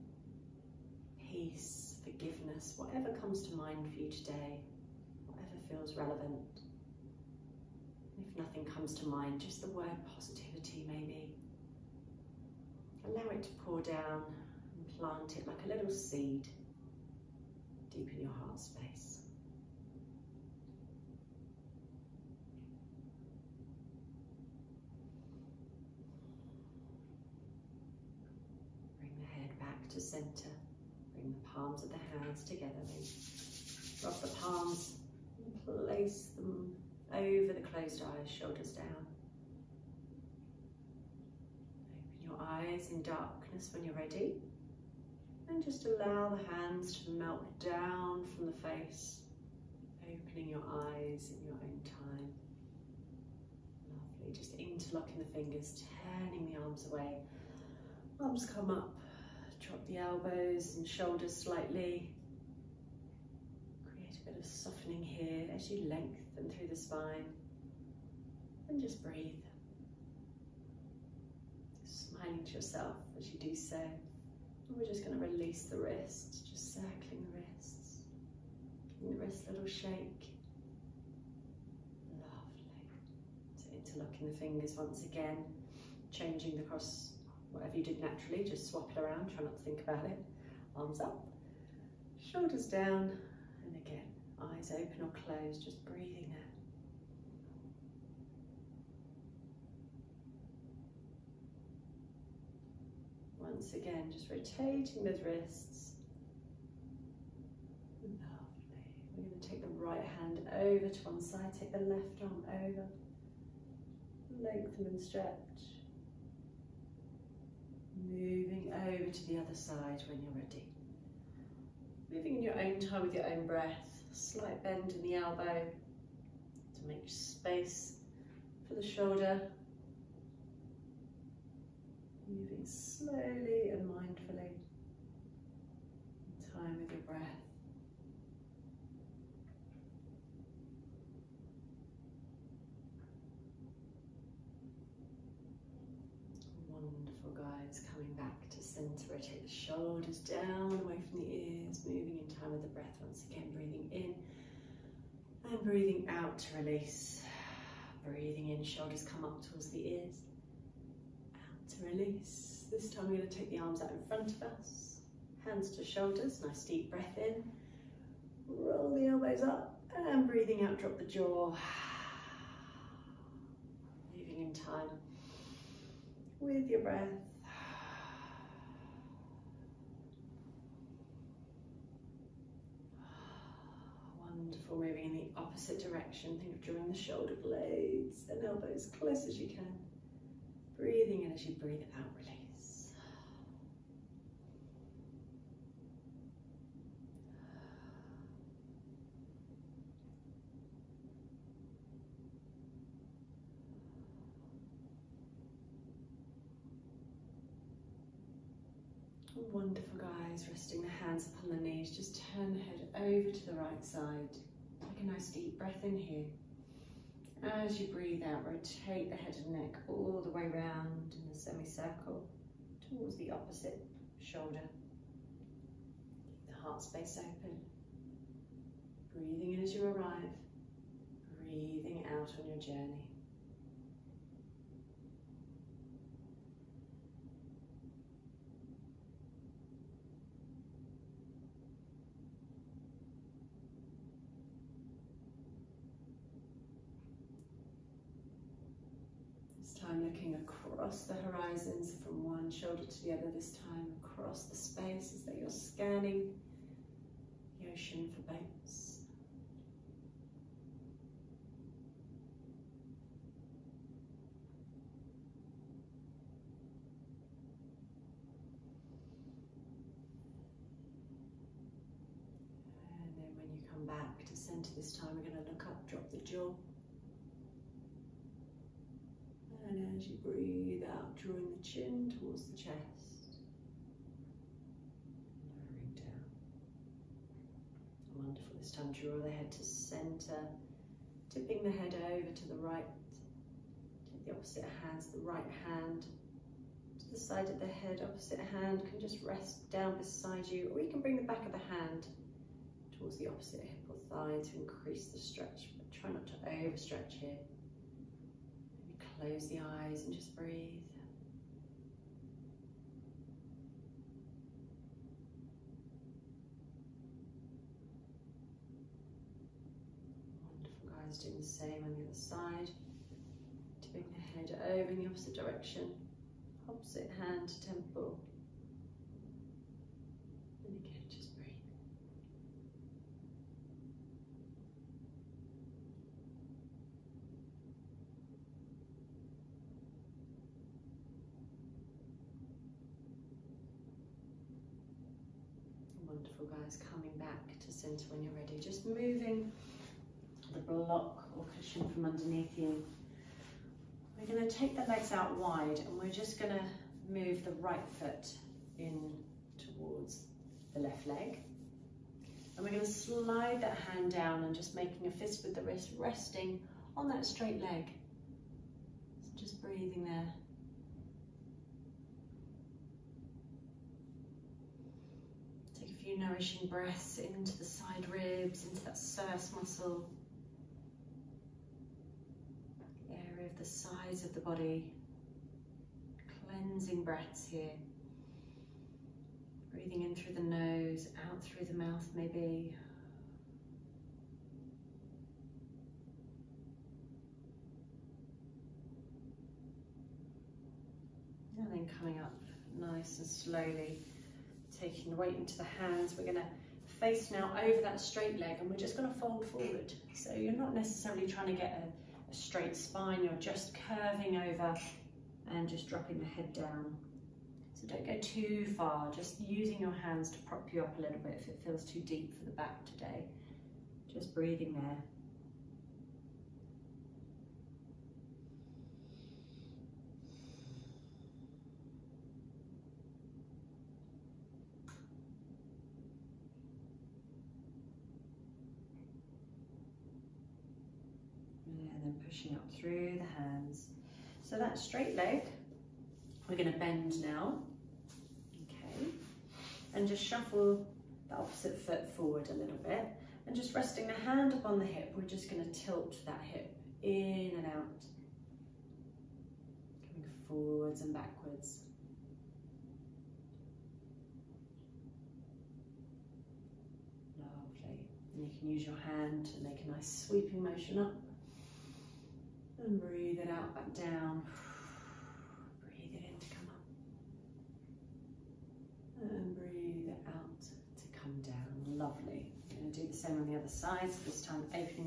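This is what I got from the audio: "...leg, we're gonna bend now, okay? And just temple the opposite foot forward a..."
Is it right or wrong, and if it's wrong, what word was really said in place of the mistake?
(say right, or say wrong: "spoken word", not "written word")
wrong: "shuffle", not "temple".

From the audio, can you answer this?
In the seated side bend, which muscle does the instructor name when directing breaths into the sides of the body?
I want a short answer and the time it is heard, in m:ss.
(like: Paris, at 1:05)
psoas, at 6:18.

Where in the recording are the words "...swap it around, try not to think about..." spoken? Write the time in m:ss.
1:28.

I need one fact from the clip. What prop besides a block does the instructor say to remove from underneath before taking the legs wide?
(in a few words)
cushion.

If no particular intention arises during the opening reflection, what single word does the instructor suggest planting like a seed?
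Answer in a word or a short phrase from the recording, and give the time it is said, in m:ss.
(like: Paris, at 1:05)
positivity, at 0:10.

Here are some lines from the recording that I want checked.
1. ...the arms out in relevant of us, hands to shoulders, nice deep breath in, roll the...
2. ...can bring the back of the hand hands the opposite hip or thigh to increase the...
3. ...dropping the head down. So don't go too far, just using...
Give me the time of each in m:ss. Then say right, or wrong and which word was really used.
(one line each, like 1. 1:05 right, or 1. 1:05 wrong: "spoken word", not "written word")
1. 2:43 wrong: "front", not "relevant"
2. 5:00 wrong: "towards", not "hands"
3. 6:55 right.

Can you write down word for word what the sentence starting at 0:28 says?
Bring the head back to centre palms of the hands together.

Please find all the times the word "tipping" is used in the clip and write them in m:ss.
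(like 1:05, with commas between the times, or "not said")
4:51, 5:23.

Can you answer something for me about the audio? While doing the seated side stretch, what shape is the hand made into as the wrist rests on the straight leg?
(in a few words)
a fist.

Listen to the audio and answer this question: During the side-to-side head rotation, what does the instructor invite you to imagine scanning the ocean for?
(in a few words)
boats.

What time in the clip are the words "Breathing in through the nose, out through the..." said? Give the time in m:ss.
6:29.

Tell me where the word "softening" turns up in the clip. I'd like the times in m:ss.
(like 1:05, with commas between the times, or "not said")
1:04.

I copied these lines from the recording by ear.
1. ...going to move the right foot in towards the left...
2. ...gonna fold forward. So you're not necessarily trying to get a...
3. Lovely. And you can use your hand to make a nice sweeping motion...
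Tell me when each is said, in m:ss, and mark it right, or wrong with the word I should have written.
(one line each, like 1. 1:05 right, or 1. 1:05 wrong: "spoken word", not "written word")
1. 5:56 right
2. 6:48 right
3. 7:47 right.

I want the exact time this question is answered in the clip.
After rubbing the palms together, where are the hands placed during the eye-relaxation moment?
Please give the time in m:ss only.
0:37.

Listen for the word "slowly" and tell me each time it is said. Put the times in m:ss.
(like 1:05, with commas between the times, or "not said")
2:12, 6:43.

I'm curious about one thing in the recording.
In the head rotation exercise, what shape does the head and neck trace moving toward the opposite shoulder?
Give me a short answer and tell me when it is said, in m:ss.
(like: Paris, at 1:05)
a semicircle, at 3:41.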